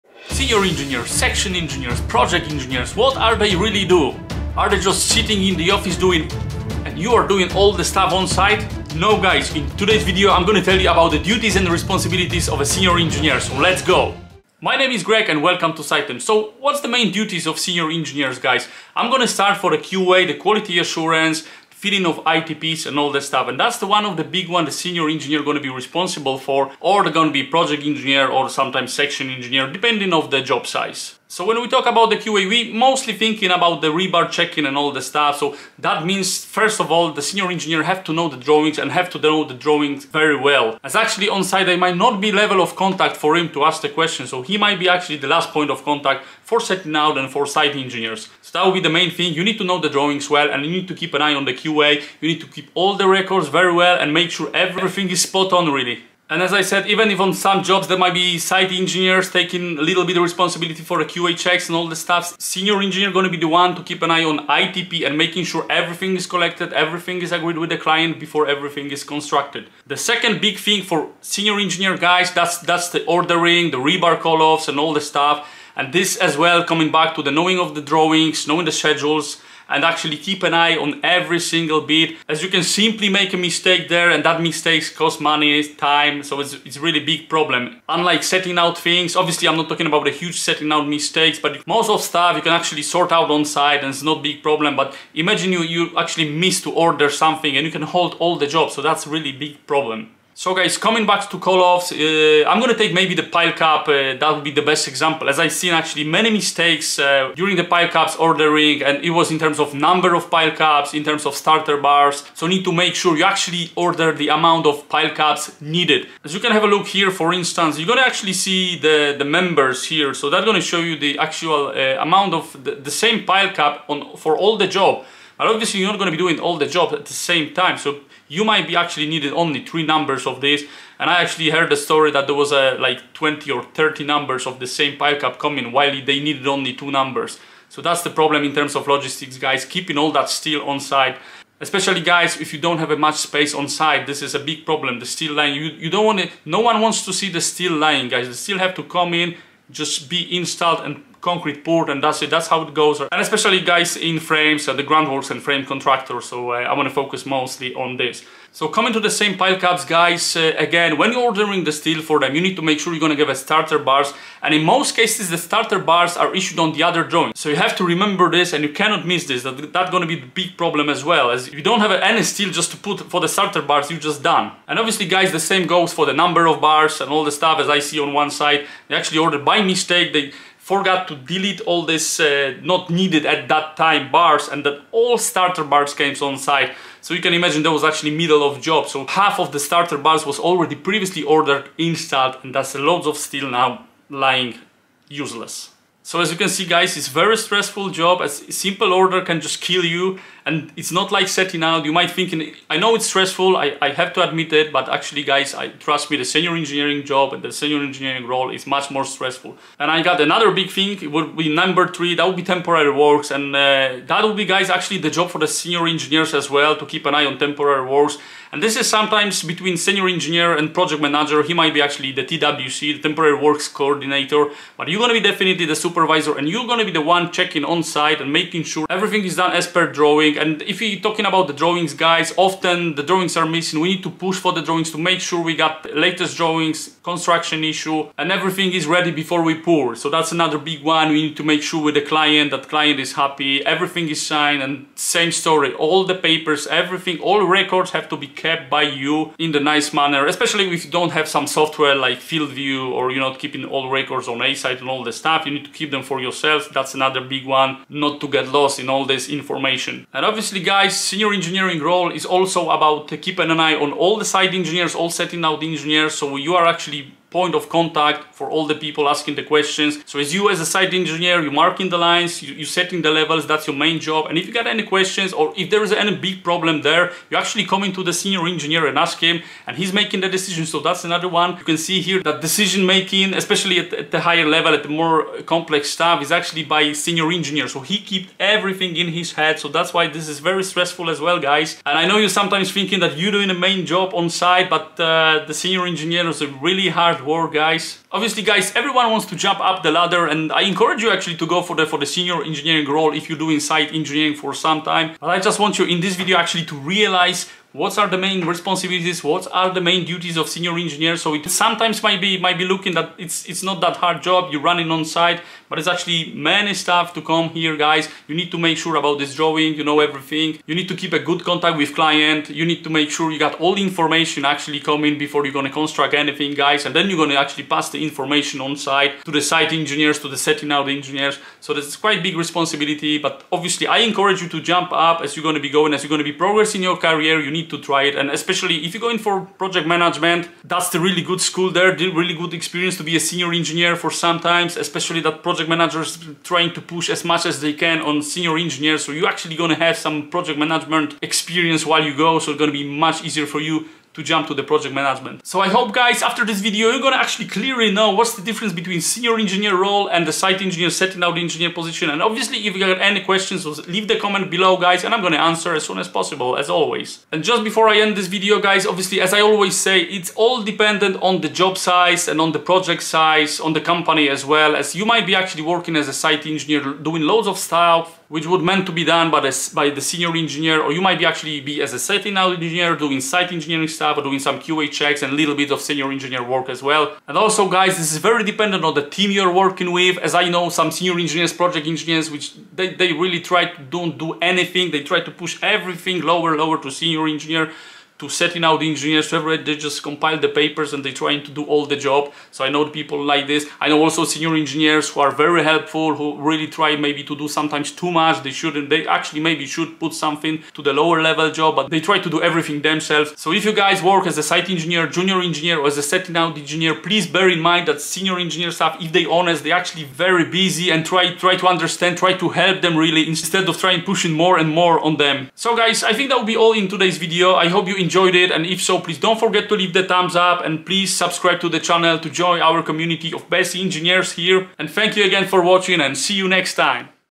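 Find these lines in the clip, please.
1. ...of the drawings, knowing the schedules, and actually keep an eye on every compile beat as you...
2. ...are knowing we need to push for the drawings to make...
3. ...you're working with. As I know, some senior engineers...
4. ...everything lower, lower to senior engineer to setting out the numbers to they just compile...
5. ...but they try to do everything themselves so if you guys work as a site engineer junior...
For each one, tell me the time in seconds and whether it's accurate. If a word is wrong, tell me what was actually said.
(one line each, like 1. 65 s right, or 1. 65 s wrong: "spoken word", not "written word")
1. 77 s wrong: "single", not "compile"
2. 233 s wrong: "missing", not "knowing"
3. 389 s right
4. 395 s wrong: "engineers", not "numbers"
5. 411 s right.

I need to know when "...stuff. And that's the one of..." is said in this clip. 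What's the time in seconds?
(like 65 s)
23 s.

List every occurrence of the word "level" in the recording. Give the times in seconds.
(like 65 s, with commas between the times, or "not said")
42 s, 273 s, 284 s, 411 s.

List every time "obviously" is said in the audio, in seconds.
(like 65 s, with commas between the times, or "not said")
89 s, 125 s, 174 s, 260 s, 298 s, 333 s, 362 s, 368 s.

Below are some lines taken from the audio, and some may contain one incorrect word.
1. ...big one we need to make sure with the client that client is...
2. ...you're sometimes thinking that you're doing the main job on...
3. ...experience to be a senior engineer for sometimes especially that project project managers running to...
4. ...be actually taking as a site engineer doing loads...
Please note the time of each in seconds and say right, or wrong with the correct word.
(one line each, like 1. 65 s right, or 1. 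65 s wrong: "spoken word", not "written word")
1. 240 s right
2. 292 s right
3. 342 s wrong: "trying", not "running"
4. 375 s wrong: "working", not "taking".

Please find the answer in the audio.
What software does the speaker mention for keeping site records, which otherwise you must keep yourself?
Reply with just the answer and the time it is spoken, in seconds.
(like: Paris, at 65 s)
FieldView, at 252 s.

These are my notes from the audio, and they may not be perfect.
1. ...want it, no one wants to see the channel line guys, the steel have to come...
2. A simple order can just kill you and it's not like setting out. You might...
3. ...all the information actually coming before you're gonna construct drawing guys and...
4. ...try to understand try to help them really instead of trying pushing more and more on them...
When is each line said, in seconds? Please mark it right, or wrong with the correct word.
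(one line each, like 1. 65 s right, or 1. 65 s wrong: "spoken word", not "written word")
1. 146 s wrong: "steel", not "channel"
2. 198 s right
3. 323 s wrong: "anything", not "drawing"
4. 421 s right.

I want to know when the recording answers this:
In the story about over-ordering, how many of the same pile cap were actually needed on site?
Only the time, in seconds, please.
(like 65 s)
136 s.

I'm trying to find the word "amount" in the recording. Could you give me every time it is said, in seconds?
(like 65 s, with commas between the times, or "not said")
114 s, 122 s.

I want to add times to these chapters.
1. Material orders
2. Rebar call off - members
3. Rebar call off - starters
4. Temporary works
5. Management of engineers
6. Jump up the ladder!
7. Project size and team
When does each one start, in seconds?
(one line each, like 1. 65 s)
1. 70 s
2. 101 s
3. 160 s
4. 210 s
5. 260 s
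6. 333 s
7. 367 s.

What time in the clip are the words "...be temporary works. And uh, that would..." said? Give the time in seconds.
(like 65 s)
212 s.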